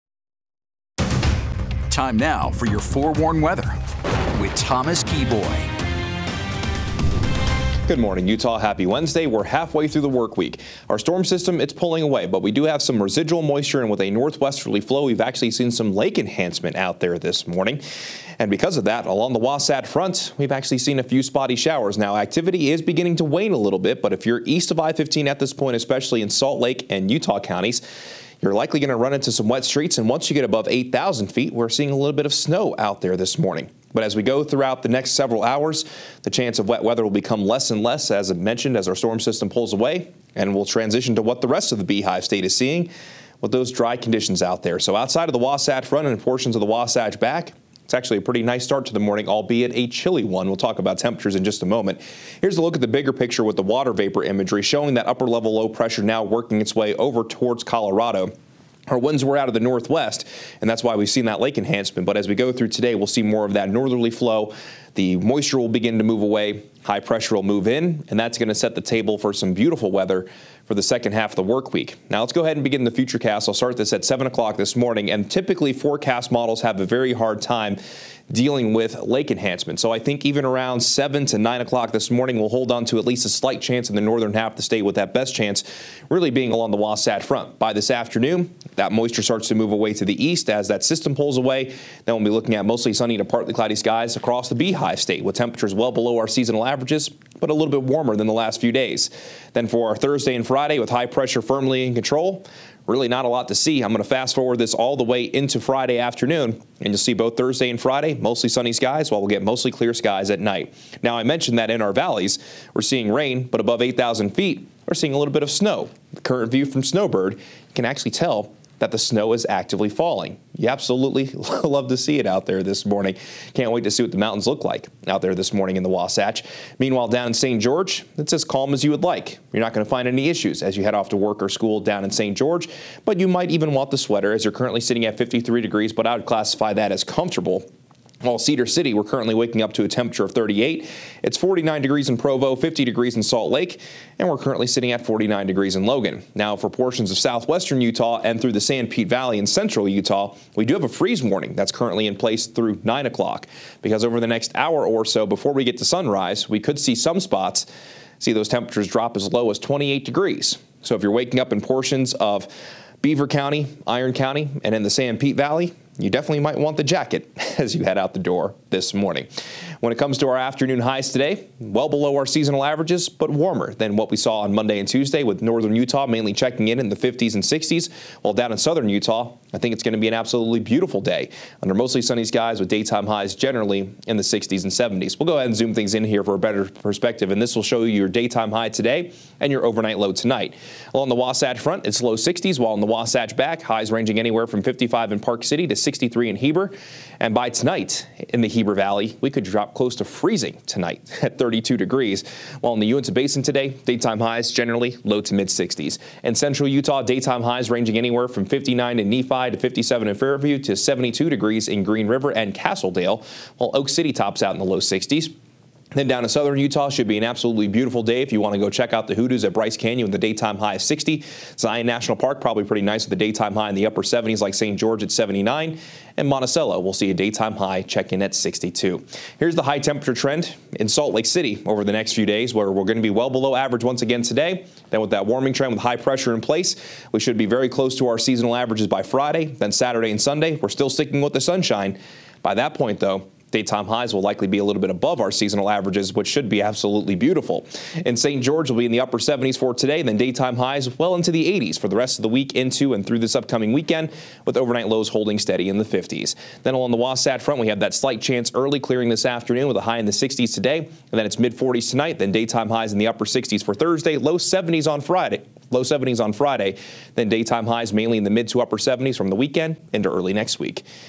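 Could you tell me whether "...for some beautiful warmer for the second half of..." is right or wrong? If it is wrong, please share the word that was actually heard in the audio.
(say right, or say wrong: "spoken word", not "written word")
wrong: "weather", not "warmer".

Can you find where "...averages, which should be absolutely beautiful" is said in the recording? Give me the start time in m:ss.
4:05.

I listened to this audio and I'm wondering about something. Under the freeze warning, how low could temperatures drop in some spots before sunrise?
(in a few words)
28 degrees.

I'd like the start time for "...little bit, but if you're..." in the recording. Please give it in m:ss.
0:23.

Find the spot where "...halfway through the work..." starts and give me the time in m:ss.
0:09.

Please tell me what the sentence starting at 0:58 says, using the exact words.
Our winds were out of the northwest, and that's why we've seen that lake enhancement.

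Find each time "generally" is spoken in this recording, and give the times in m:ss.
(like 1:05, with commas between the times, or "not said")
3:03, 3:24.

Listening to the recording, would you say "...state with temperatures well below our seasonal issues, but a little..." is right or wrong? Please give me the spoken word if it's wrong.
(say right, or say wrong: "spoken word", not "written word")
wrong: "averages", not "issues".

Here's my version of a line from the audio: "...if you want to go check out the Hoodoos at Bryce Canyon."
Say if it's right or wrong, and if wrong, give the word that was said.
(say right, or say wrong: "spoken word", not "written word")
right.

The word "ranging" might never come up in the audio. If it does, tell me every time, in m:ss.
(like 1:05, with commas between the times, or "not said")
3:13, 3:27.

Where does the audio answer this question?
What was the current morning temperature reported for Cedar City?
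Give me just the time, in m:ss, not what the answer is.
2:20.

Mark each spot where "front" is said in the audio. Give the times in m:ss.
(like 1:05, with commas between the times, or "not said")
0:19, 0:45, 1:27, 3:11, 4:17.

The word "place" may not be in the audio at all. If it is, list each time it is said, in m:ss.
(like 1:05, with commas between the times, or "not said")
2:32, 3:56.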